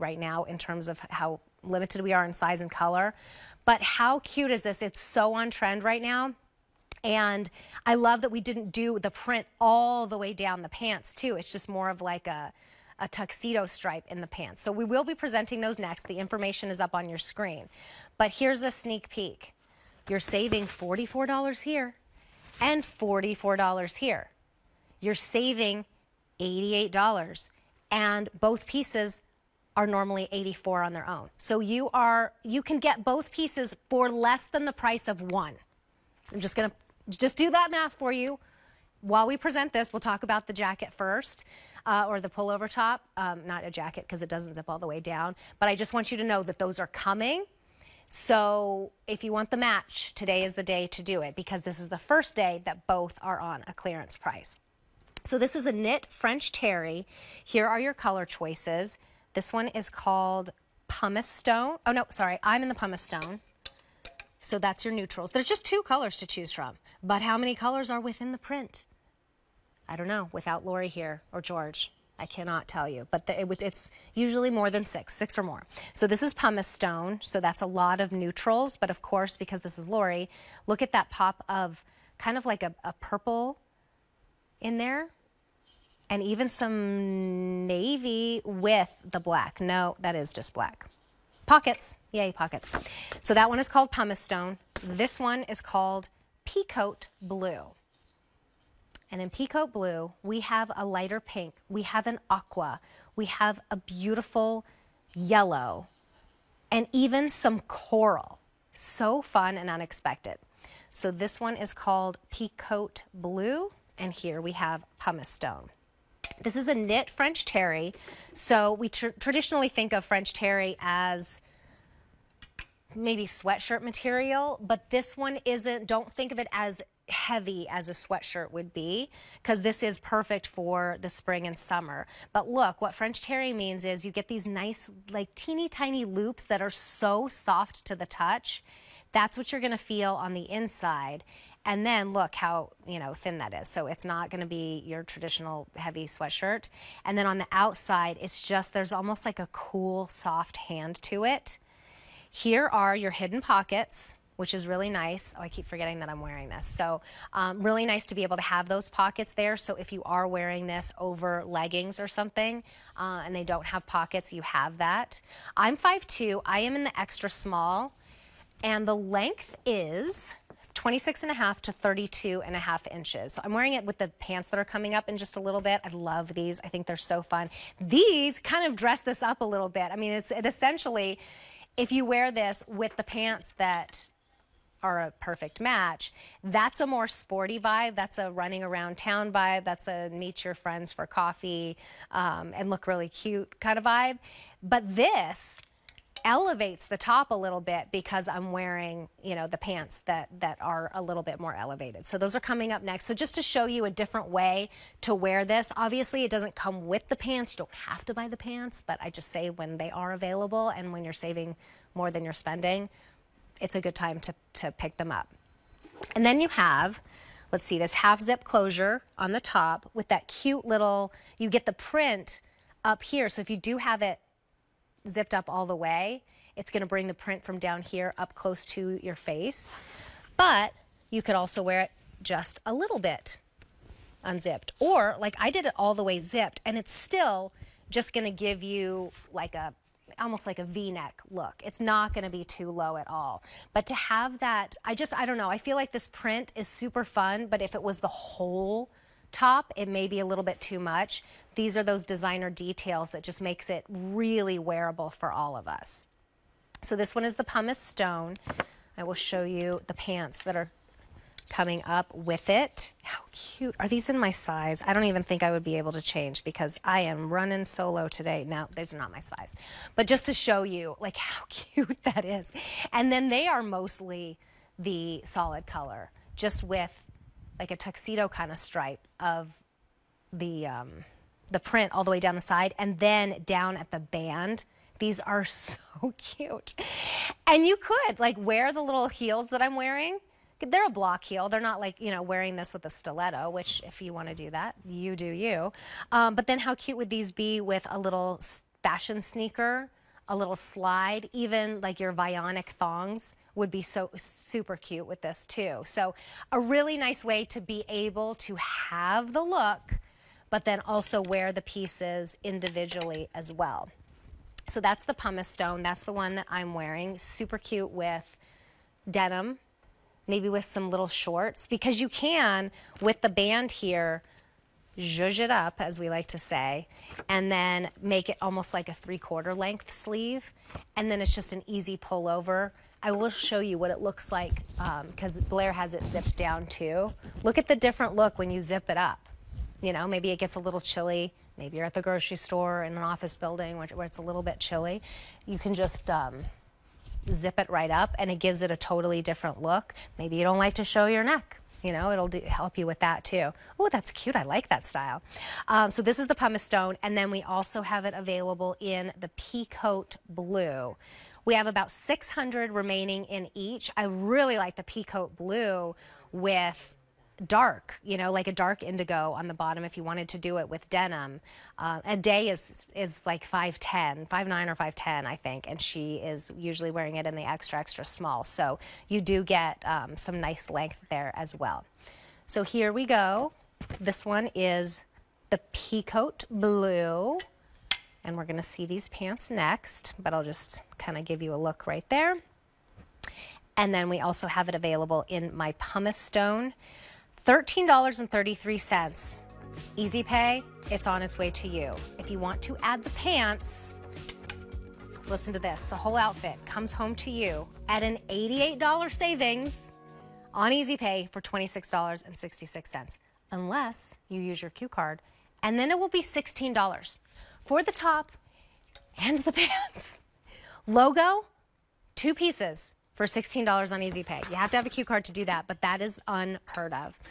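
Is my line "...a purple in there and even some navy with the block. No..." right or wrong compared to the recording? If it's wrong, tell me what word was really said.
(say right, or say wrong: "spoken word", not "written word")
wrong: "black", not "block".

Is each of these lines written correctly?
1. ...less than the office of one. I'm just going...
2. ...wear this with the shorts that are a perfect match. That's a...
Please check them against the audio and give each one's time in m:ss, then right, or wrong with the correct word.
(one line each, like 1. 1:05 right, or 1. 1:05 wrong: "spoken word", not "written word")
1. 0:34 wrong: "price", not "office"
2. 3:02 wrong: "pants", not "shorts".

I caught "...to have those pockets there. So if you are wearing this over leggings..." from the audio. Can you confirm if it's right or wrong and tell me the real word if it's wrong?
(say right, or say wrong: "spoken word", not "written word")
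right.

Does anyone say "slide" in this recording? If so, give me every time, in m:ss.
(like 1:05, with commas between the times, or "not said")
5:00.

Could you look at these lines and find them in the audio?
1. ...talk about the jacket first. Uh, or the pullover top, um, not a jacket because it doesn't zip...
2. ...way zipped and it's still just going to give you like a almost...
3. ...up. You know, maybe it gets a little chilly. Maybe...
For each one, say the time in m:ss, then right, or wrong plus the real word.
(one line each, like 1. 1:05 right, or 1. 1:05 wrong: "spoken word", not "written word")
1. 0:40 right
2. 3:56 right
3. 5:38 right.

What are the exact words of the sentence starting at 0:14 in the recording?
So we will be presenting those next.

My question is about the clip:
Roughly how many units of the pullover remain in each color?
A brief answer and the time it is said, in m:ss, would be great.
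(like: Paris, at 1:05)
About 600, at 6:01.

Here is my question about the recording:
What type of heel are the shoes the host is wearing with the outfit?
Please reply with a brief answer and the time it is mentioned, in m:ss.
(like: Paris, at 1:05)
Block heel, at 4:50.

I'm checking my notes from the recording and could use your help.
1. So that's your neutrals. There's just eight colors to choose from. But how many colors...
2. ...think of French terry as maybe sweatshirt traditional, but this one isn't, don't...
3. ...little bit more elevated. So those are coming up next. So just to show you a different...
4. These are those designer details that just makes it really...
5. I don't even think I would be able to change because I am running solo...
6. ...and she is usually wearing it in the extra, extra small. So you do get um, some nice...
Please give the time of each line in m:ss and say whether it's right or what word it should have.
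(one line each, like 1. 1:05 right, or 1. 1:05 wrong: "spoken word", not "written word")
1. 1:04 wrong: "two", not "eight"
2. 1:59 wrong: "material", not "traditional"
3. 3:21 right
4. 4:11 right
5. 4:24 right
6. 6:15 right.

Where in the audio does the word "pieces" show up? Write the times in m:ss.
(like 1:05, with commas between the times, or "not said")
0:28, 0:33, 5:11, 7:02.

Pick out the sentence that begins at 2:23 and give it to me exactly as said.
So it's not going to be your traditional heavy sweatshirt.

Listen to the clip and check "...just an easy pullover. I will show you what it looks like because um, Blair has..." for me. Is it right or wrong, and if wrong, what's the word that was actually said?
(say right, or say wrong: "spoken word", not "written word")
right.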